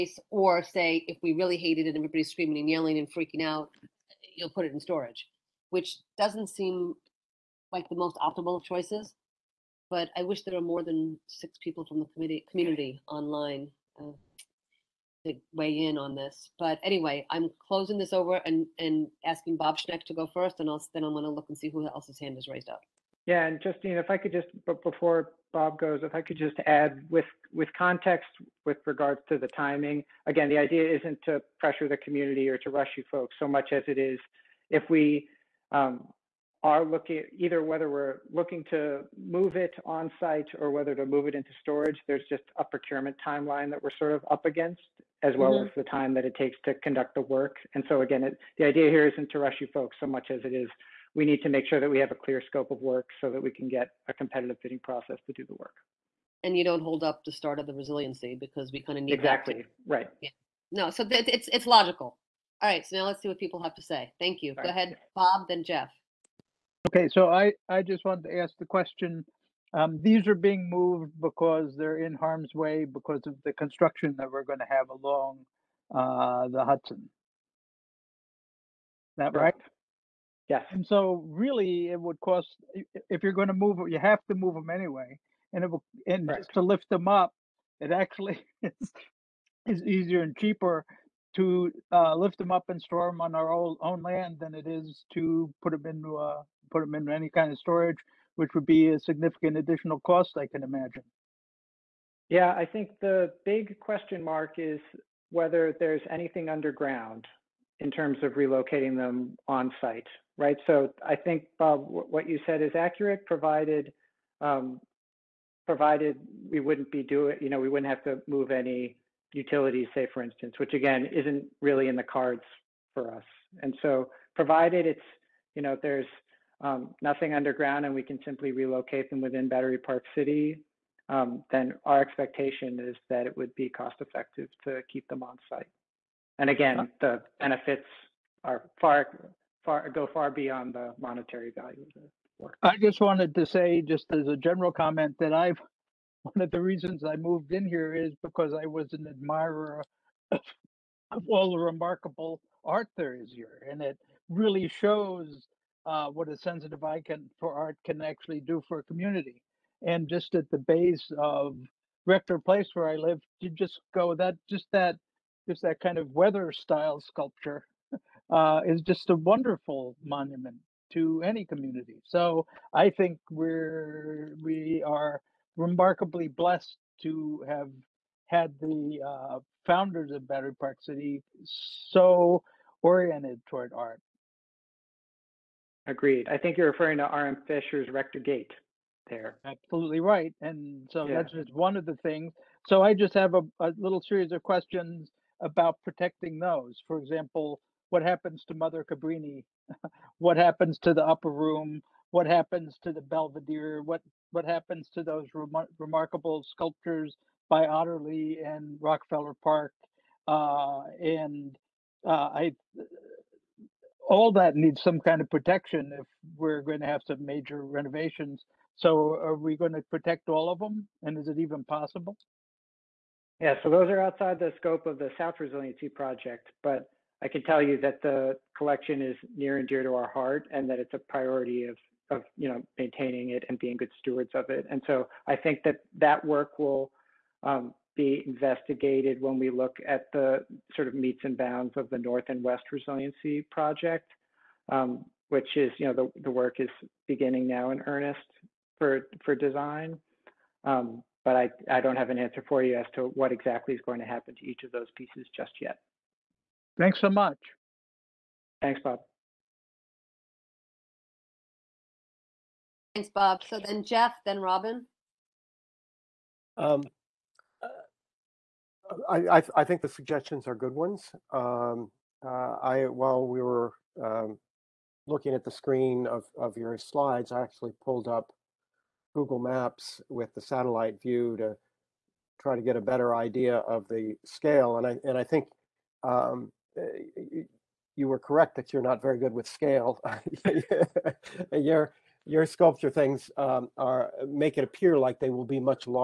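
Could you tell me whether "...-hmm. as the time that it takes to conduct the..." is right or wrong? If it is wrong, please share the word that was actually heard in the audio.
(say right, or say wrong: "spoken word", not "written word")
right.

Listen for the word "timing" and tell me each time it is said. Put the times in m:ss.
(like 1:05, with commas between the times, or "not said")
0:29.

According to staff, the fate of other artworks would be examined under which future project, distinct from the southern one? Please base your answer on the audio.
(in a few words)
North and West Resiliency Project.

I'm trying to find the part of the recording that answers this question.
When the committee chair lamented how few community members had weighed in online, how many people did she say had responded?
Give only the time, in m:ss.
0:11.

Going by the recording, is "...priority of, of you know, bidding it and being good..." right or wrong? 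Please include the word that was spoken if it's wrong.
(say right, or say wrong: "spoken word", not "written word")
wrong: "maintaining", not "bidding".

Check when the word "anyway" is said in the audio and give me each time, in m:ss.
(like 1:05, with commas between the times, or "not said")
0:16, 1:24.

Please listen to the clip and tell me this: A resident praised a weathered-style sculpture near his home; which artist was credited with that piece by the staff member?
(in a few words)
R.M. Fischer.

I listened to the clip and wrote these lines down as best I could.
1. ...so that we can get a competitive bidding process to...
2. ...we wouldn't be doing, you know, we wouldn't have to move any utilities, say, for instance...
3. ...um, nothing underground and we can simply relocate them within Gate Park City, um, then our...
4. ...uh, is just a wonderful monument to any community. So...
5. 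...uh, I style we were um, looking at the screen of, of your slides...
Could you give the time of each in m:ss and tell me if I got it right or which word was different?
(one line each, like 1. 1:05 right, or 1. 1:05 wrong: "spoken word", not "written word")
1. 0:53 right
2. 1:56 right
3. 2:06 wrong: "Battery", not "Gate"
4. 2:48 right
5. 4:32 wrong: "while", not "style".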